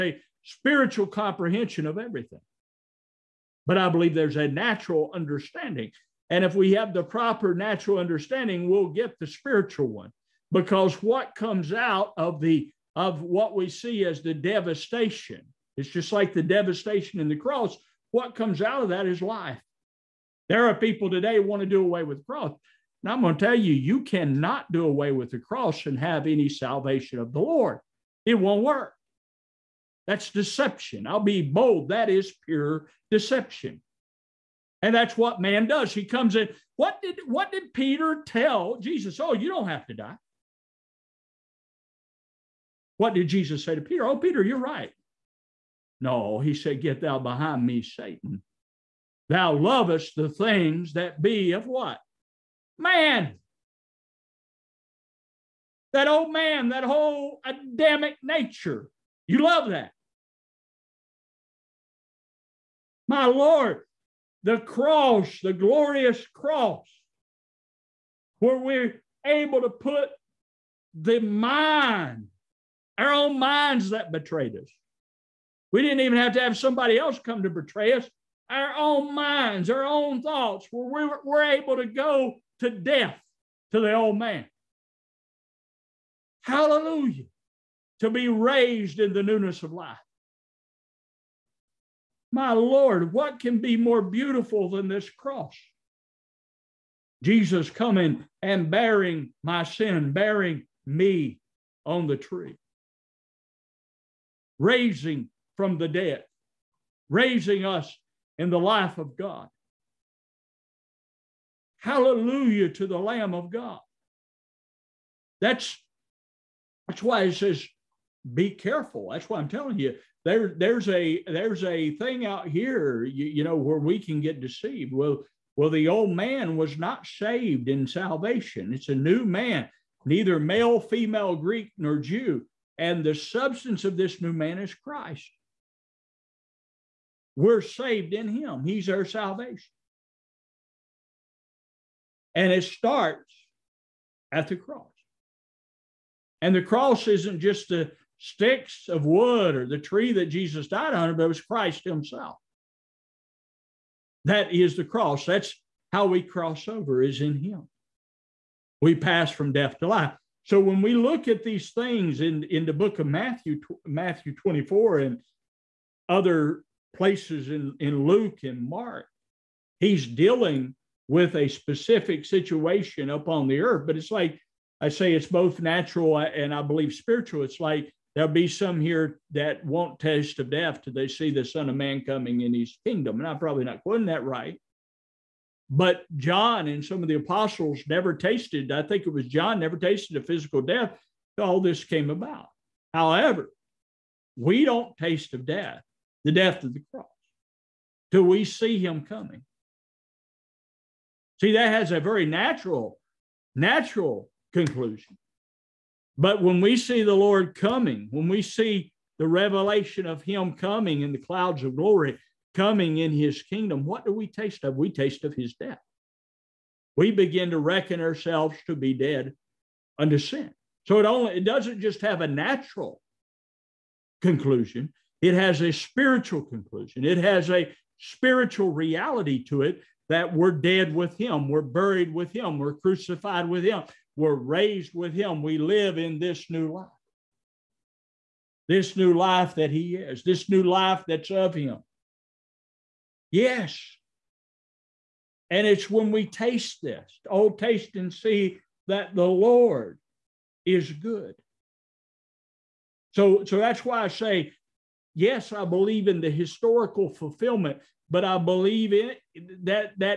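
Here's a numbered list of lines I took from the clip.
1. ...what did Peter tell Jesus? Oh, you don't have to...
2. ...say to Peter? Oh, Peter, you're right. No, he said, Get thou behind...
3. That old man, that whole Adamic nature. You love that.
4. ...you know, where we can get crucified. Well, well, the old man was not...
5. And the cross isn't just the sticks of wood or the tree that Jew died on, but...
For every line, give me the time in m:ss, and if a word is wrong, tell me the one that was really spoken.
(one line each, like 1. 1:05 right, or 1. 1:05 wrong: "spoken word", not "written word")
1. 0:37 right
2. 0:43 right
3. 0:55 right
4. 2:03 wrong: "deceived", not "crucified"
5. 2:26 wrong: "Jesus", not "Jew".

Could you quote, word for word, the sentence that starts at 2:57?
It's like there'll be some here that won't taste of death till they see the Son of Man coming in his kingdom.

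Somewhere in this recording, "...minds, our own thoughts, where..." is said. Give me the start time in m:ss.
1:19.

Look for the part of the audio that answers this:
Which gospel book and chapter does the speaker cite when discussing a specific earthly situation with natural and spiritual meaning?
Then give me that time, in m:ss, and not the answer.
2:43.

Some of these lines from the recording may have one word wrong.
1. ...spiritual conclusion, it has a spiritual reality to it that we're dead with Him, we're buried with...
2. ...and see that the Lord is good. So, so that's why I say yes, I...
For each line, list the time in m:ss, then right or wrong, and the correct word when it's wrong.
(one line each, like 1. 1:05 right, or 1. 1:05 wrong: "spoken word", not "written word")
1. 3:45 right
2. 4:07 right.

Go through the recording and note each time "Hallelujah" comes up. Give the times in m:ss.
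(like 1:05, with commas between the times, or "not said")
1:26, 1:51.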